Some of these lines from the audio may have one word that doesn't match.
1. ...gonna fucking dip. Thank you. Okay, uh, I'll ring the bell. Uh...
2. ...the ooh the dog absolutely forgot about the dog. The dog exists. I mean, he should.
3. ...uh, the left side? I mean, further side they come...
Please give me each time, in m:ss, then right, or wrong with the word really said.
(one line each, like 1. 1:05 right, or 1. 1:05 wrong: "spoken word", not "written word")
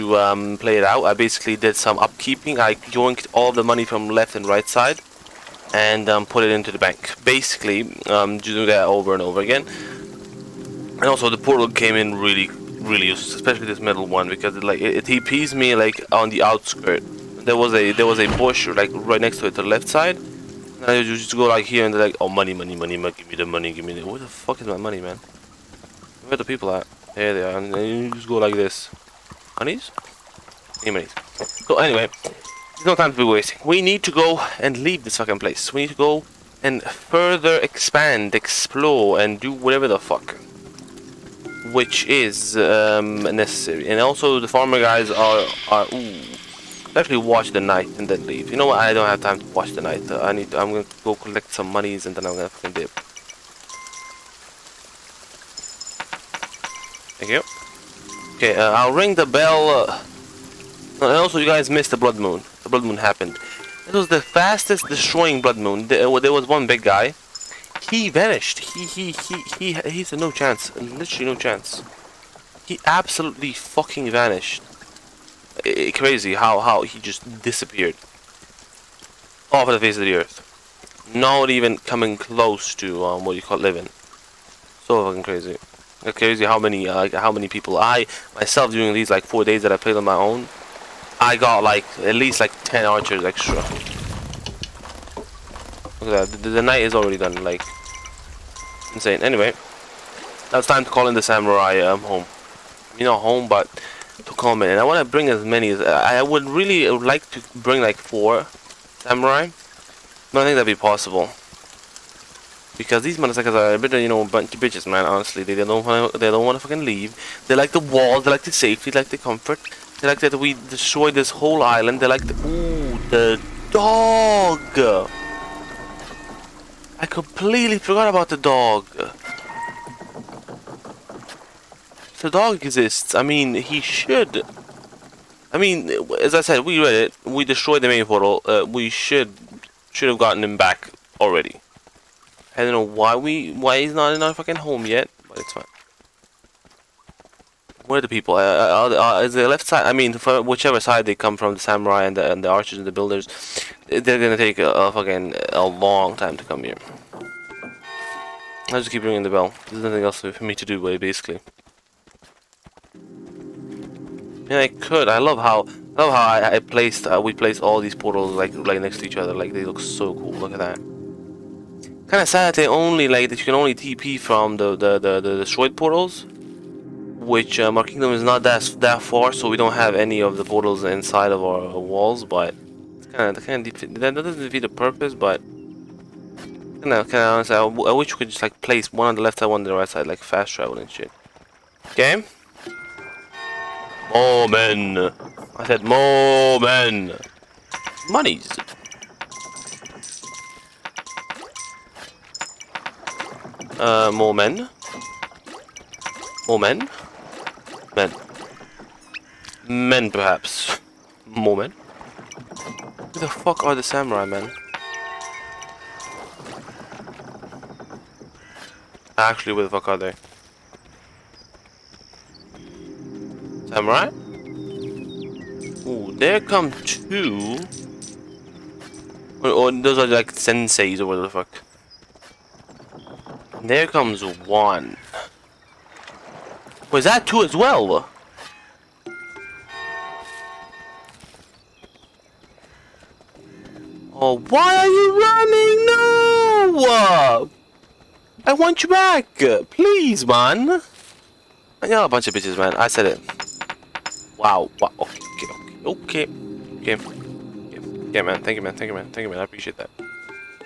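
1. 0:52 right
2. 2:02 wrong: "completely", not "absolutely"
3. 2:28 wrong: "whichever", not "further".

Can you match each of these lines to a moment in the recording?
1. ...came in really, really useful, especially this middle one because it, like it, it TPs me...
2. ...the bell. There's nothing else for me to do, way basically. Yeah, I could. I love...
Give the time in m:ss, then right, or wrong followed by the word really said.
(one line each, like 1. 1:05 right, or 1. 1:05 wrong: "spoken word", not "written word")
1. 0:11 right
2. 2:39 right.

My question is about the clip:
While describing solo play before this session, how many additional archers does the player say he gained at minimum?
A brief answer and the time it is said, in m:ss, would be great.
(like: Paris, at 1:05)
10, at 1:32.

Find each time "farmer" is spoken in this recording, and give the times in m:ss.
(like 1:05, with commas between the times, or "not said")
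0:44.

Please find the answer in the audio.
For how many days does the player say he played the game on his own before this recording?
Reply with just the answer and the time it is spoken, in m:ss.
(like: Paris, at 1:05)
4, at 1:29.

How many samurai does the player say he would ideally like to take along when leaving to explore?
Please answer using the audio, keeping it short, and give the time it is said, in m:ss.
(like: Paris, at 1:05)
4, at 1:47.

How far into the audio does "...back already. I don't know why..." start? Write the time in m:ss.
2:20.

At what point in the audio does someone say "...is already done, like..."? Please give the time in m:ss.
1:36.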